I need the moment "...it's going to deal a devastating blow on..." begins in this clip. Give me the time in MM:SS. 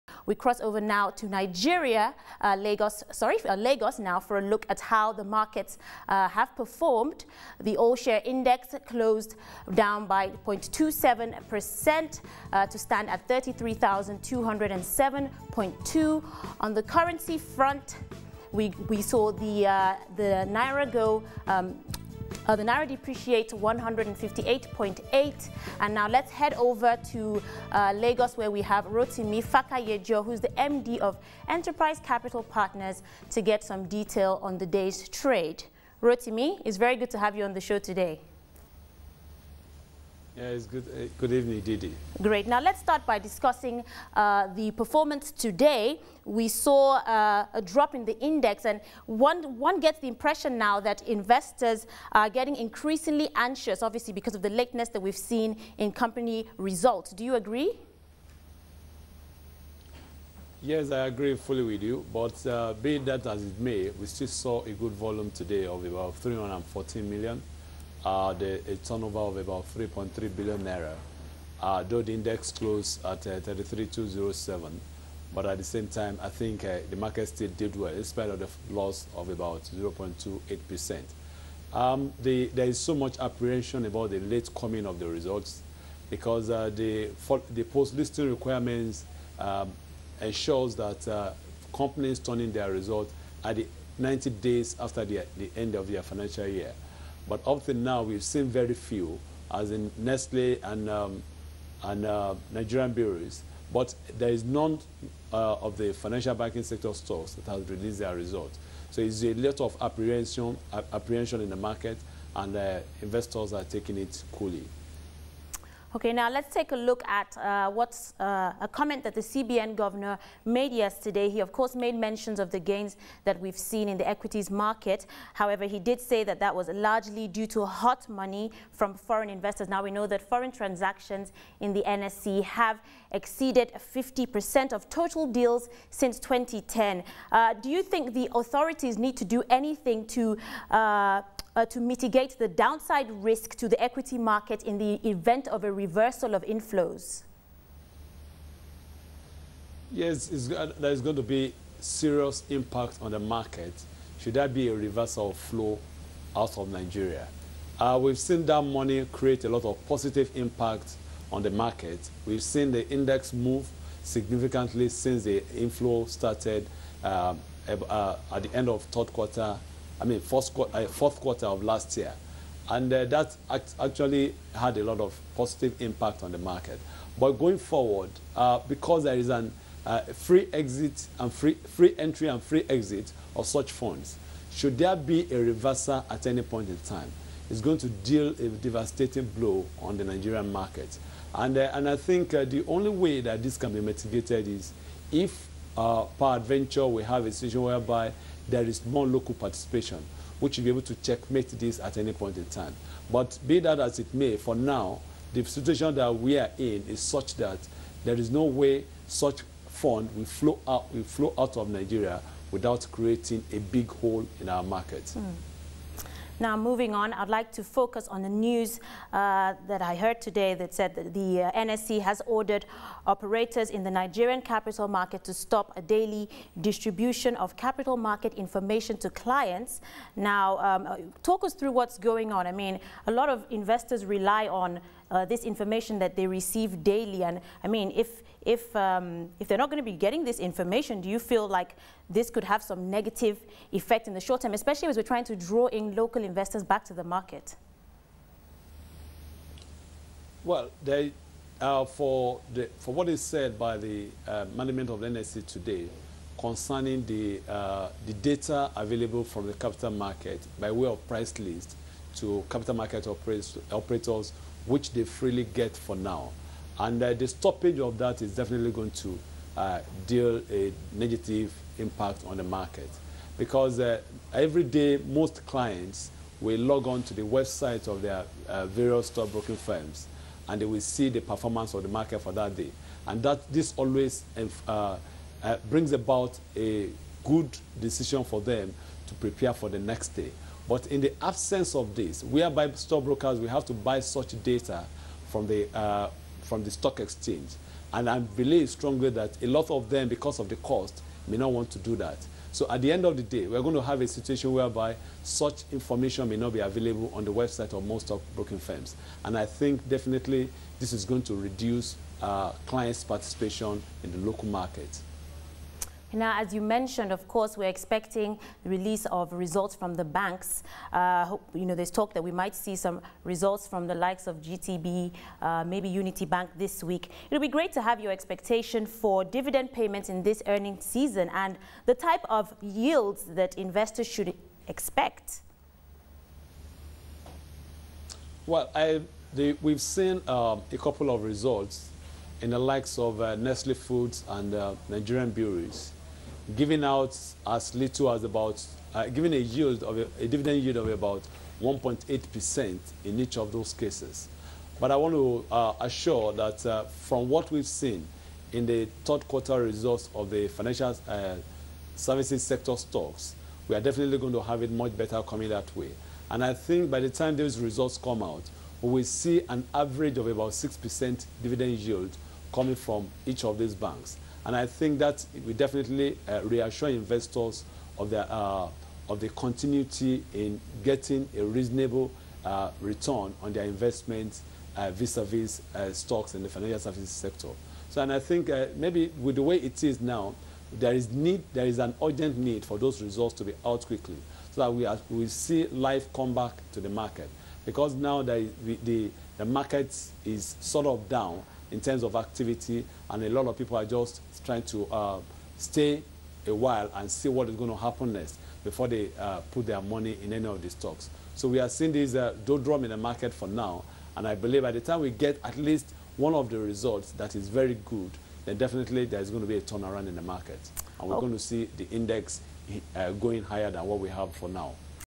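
03:07.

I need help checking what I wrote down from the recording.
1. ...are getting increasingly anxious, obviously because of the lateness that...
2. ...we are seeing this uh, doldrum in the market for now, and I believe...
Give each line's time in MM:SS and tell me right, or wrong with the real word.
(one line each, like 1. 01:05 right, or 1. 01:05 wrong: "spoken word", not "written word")
1. 00:52 right
2. 06:51 right.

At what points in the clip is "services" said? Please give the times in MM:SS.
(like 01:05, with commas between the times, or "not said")
06:01, 06:26.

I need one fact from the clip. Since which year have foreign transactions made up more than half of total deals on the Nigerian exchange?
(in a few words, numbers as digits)
2010.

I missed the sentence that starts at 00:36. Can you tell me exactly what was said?
Rotimi, it's very good to have you on the show today.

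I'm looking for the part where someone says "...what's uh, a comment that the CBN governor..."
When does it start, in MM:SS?
01:57.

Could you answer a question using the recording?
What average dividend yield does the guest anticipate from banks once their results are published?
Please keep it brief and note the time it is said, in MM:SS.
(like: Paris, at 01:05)
6%, at 06:10.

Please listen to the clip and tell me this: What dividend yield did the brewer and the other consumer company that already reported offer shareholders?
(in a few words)
1.8%.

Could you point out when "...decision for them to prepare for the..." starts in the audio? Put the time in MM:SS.
04:47.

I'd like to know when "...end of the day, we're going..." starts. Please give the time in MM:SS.
05:02.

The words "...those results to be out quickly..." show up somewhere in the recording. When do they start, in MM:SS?
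06:32.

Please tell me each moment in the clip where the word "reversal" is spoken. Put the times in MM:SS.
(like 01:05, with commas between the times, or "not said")
02:25, 02:34, 03:05.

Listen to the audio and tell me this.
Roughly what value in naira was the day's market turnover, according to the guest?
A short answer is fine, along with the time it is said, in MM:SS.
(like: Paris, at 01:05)
3.3 billion naira, at 01:09.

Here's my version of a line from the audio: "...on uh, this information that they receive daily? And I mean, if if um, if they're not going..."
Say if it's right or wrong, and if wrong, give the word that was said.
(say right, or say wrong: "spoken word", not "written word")
right.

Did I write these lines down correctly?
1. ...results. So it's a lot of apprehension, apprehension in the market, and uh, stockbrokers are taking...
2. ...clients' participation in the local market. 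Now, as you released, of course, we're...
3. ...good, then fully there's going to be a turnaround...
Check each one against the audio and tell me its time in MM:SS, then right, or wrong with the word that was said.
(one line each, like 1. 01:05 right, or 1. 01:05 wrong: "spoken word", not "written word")
1. 01:48 wrong: "investors", not "stockbrokers"
2. 05:12 wrong: "mentioned", not "released"
3. 06:57 wrong: "definitely", not "fully".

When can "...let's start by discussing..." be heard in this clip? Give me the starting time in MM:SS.
00:42.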